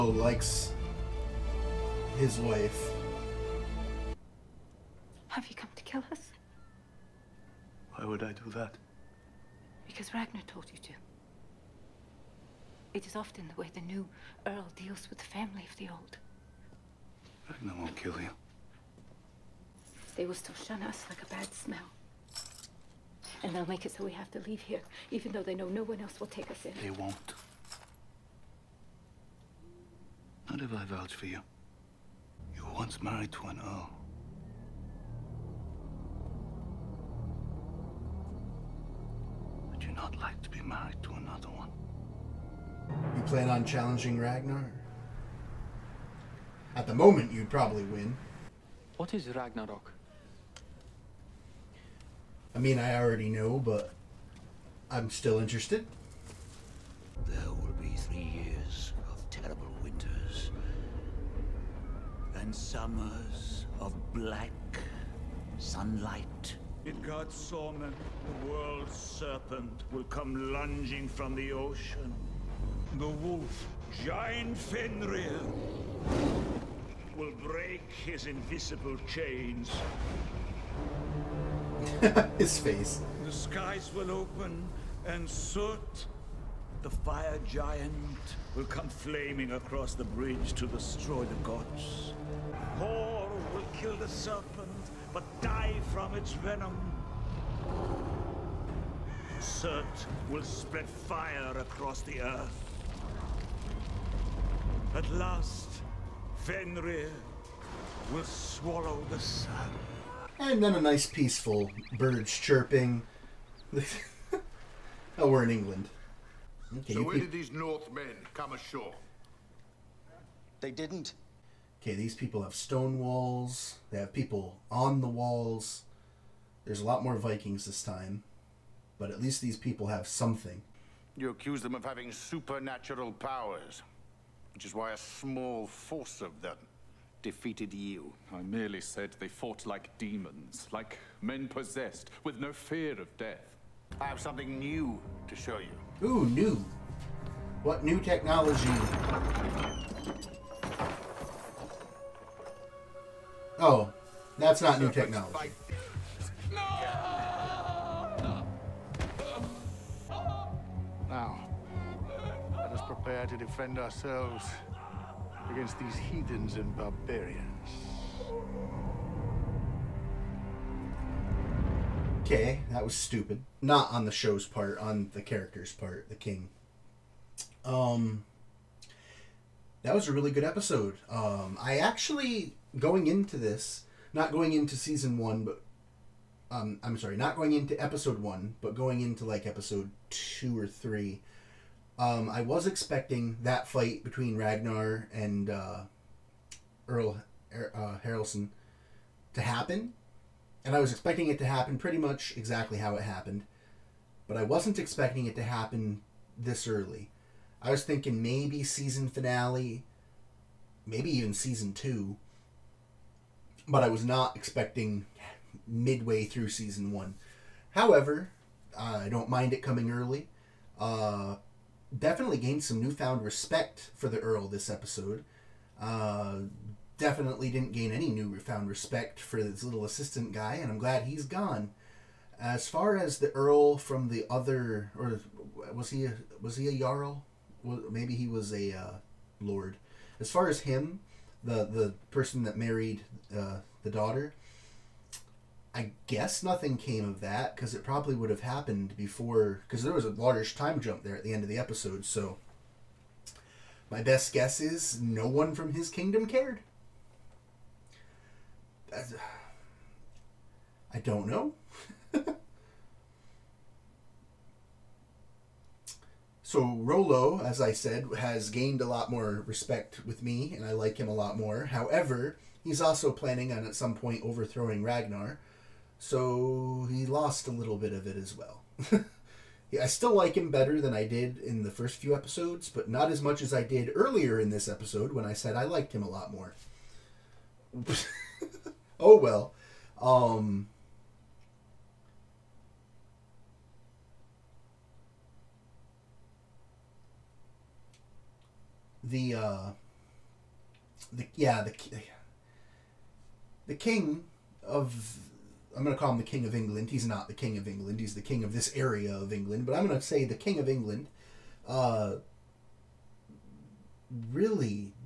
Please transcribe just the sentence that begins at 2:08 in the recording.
But at least these people have something.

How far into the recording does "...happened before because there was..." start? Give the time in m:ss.
4:08.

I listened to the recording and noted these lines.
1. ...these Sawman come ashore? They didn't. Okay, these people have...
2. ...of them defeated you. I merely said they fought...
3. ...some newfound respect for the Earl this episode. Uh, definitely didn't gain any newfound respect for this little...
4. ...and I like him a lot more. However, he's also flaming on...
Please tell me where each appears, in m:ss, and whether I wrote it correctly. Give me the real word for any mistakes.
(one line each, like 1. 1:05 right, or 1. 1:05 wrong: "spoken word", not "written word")
1. 1:57 wrong: "Northmen", not "Sawman"
2. 2:16 right
3. 3:42 right
4. 4:30 wrong: "planning", not "flaming".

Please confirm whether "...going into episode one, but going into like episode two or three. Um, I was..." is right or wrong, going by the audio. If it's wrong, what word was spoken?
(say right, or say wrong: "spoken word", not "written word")
right.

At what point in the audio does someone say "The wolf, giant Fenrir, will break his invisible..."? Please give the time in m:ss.
1:12.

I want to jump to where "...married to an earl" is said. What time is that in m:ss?
0:33.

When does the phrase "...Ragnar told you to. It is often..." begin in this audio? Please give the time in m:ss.
0:10.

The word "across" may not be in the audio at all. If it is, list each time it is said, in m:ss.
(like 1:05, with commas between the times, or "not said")
1:29, 1:41.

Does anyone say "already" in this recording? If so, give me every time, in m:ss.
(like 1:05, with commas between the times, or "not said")
0:52.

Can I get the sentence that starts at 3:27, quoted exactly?
I was thinking maybe season finale, maybe even season two, but I was not expecting midway through season one.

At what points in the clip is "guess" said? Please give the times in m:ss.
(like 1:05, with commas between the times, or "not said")
4:06, 4:14.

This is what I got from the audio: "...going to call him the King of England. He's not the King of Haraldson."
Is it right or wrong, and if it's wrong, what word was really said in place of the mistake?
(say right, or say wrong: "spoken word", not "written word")
wrong: "England", not "Haraldson".